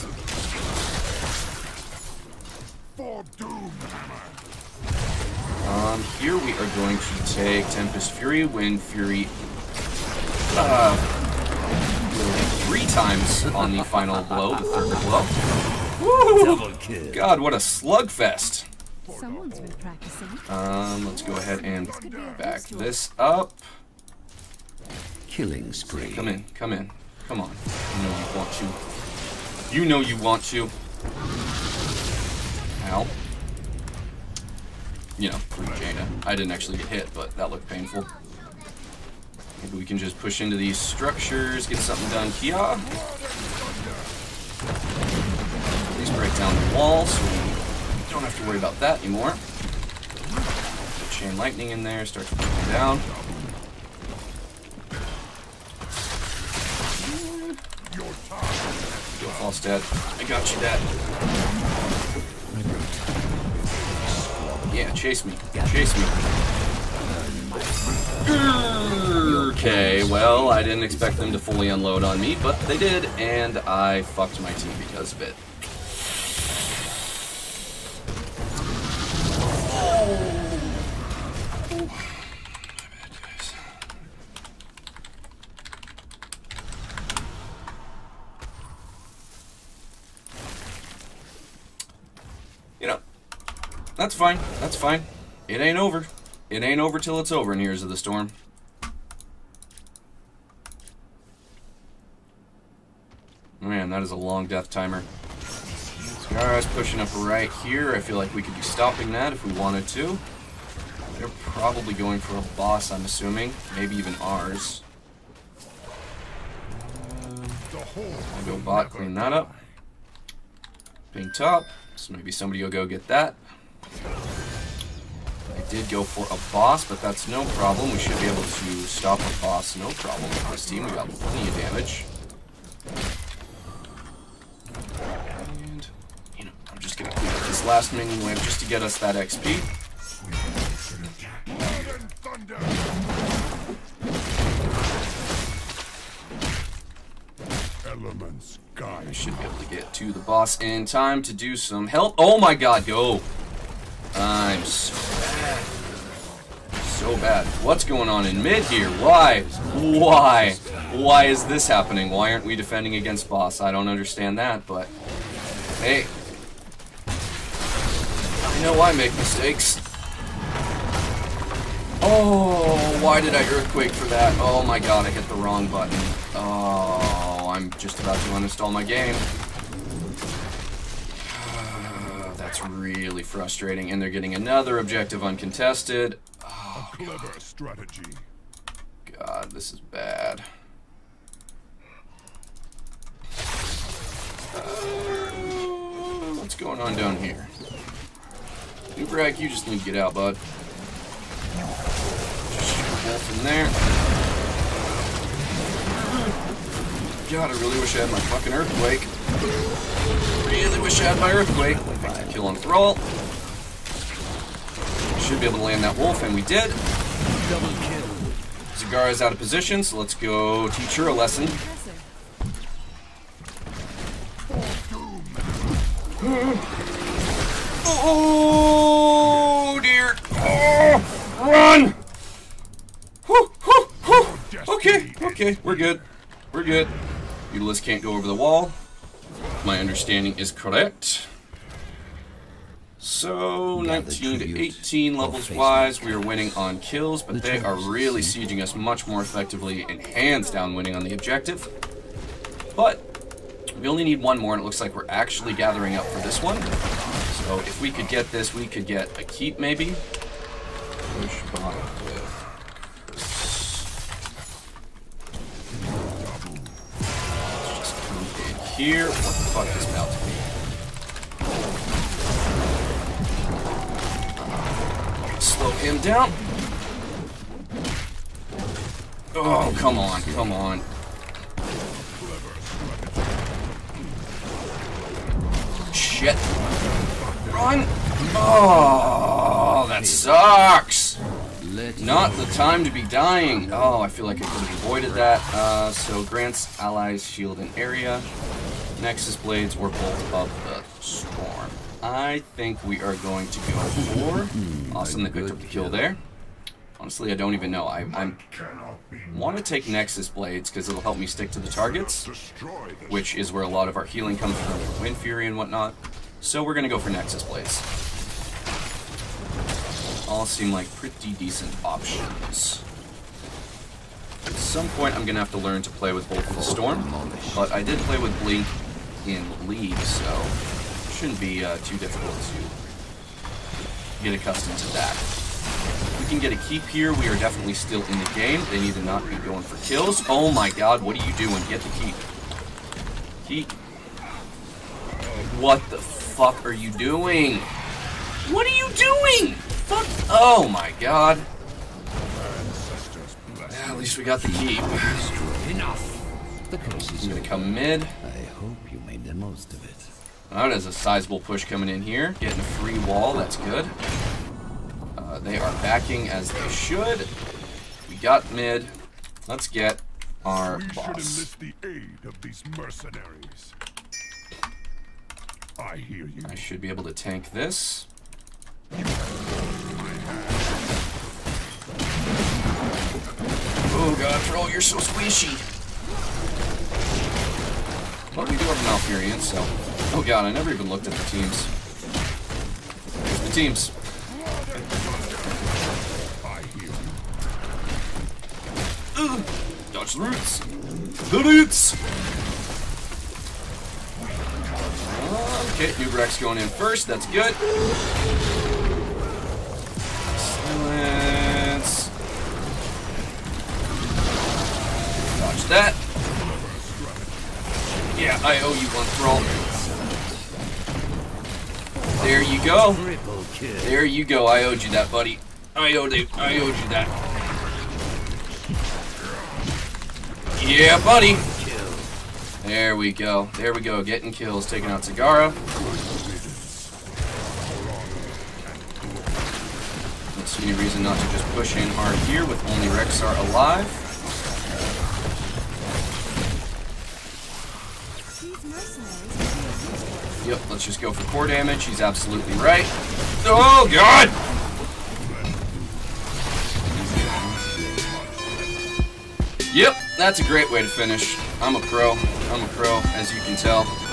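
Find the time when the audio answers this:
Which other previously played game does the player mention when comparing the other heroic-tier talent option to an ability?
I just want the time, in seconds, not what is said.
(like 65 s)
329 s.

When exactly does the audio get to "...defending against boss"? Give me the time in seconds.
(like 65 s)
162 s.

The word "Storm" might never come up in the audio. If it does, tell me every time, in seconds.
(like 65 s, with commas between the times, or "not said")
97 s, 301 s, 326 s.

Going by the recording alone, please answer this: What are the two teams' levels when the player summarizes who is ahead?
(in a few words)
19 to 18.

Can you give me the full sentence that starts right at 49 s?
Put chain lightning in there, starts breaking down.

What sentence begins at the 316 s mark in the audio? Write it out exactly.
So we're going to go for Nexus Blades all seem like pretty decent options.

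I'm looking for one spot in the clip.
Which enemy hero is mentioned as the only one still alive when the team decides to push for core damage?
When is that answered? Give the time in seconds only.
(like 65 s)
442 s.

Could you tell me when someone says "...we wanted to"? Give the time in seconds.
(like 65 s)
109 s.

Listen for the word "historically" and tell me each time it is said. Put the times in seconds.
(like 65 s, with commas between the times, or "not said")
not said.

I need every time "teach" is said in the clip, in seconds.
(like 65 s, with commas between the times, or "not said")
220 s.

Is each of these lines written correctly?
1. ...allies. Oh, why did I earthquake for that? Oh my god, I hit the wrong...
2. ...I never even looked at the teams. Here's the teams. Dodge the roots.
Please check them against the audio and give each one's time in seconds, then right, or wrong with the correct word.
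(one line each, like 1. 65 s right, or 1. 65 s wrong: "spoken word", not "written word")
1. 169 s wrong: "mistakes", not "allies"
2. 390 s right.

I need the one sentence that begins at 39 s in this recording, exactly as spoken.
Maybe we can just push into these structures, get something done here.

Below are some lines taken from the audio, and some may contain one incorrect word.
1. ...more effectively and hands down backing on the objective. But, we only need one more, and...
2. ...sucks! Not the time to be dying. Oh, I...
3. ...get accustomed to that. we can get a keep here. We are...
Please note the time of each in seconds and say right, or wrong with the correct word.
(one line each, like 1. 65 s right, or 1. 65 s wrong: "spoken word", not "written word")
1. 249 s wrong: "winning", not "backing"
2. 290 s right
3. 334 s right.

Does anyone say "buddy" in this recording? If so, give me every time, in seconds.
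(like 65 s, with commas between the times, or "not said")
425 s, 431 s.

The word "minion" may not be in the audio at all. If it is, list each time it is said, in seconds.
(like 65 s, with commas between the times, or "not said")
137 s.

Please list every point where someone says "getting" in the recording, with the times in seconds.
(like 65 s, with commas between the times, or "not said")
184 s, 362 s, 434 s.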